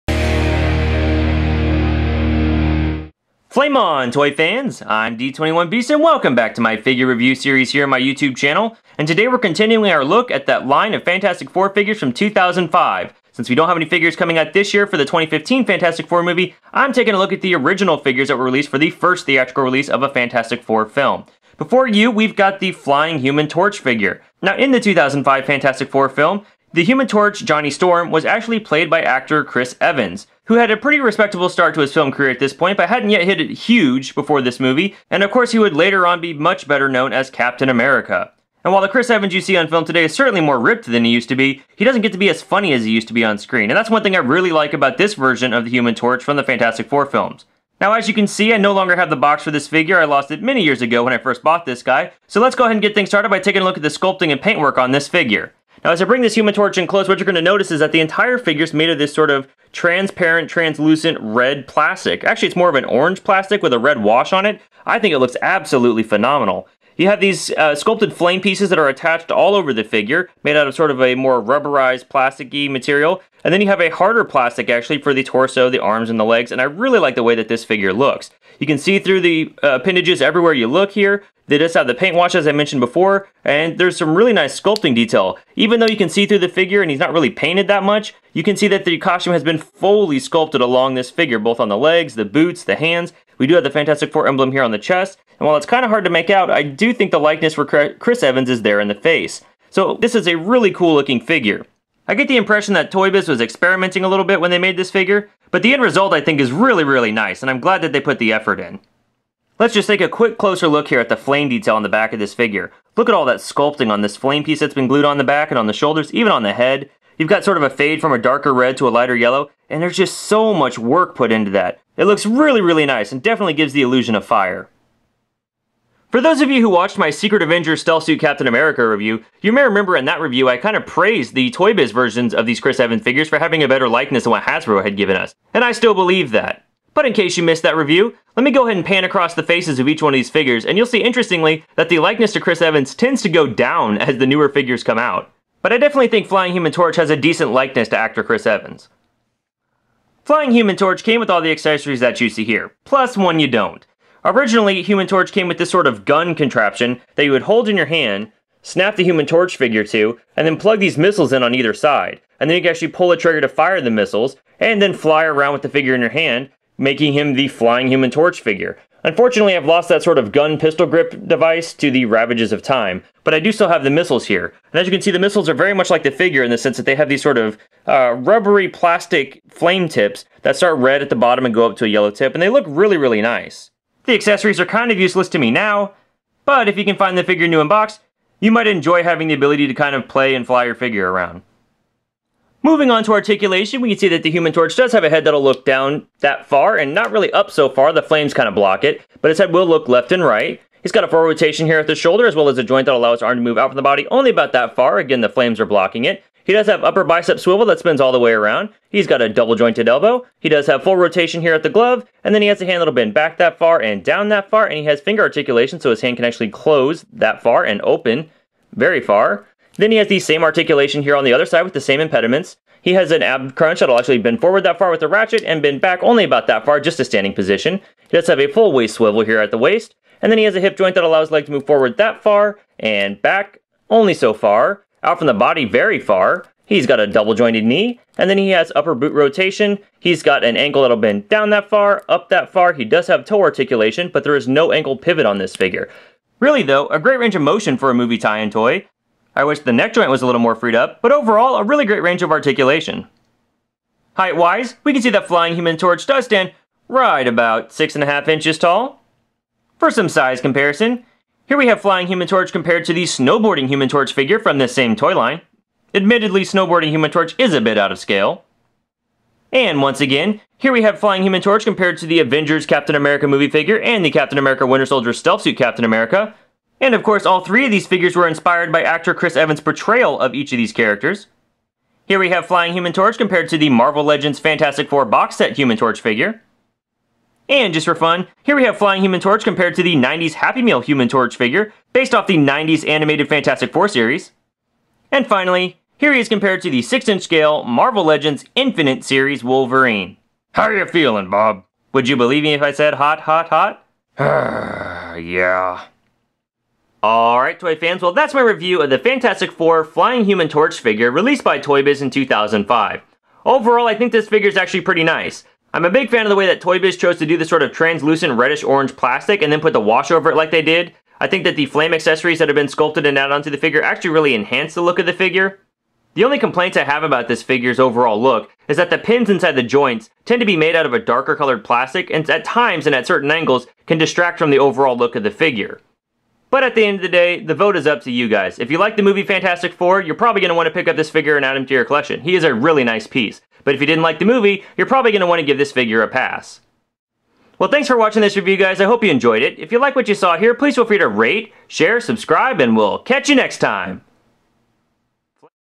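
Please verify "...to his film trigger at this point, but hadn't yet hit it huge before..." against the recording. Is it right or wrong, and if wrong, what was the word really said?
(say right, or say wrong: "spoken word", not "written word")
wrong: "career", not "trigger".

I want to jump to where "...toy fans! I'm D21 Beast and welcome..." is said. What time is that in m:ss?
0:04.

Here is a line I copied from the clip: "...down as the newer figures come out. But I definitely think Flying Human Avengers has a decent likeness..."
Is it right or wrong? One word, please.
wrong.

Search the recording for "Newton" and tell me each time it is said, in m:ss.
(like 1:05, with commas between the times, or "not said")
not said.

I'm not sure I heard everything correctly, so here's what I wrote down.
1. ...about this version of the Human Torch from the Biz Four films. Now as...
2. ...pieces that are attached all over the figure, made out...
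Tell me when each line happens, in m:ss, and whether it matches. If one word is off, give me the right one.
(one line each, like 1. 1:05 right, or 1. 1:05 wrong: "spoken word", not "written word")
1. 0:44 wrong: "Fantastic", not "Biz"
2. 1:08 right.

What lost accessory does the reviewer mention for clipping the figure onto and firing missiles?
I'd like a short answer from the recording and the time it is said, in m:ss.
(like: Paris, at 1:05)
gun pistol grip device, at 2:50.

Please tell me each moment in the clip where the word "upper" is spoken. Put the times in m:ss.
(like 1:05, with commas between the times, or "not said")
3:26, 3:58.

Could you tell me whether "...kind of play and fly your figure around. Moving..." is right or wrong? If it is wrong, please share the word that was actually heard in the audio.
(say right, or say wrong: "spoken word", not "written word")
right.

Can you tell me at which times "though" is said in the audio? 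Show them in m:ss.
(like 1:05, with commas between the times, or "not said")
1:25, 4:06.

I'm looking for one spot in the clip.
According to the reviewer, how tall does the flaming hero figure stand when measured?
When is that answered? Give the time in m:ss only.
4:17.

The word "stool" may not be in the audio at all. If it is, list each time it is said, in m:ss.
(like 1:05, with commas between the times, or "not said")
not said.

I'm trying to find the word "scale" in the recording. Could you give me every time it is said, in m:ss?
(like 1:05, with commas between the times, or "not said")
4:27, 4:57.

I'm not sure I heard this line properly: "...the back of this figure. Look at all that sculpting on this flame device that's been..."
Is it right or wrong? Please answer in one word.
wrong.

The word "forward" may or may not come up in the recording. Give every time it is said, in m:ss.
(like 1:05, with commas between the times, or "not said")
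3:21, 3:44, 3:51.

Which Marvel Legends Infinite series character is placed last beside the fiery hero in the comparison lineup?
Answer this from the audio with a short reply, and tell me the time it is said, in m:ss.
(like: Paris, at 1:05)
Wolverine, at 4:59.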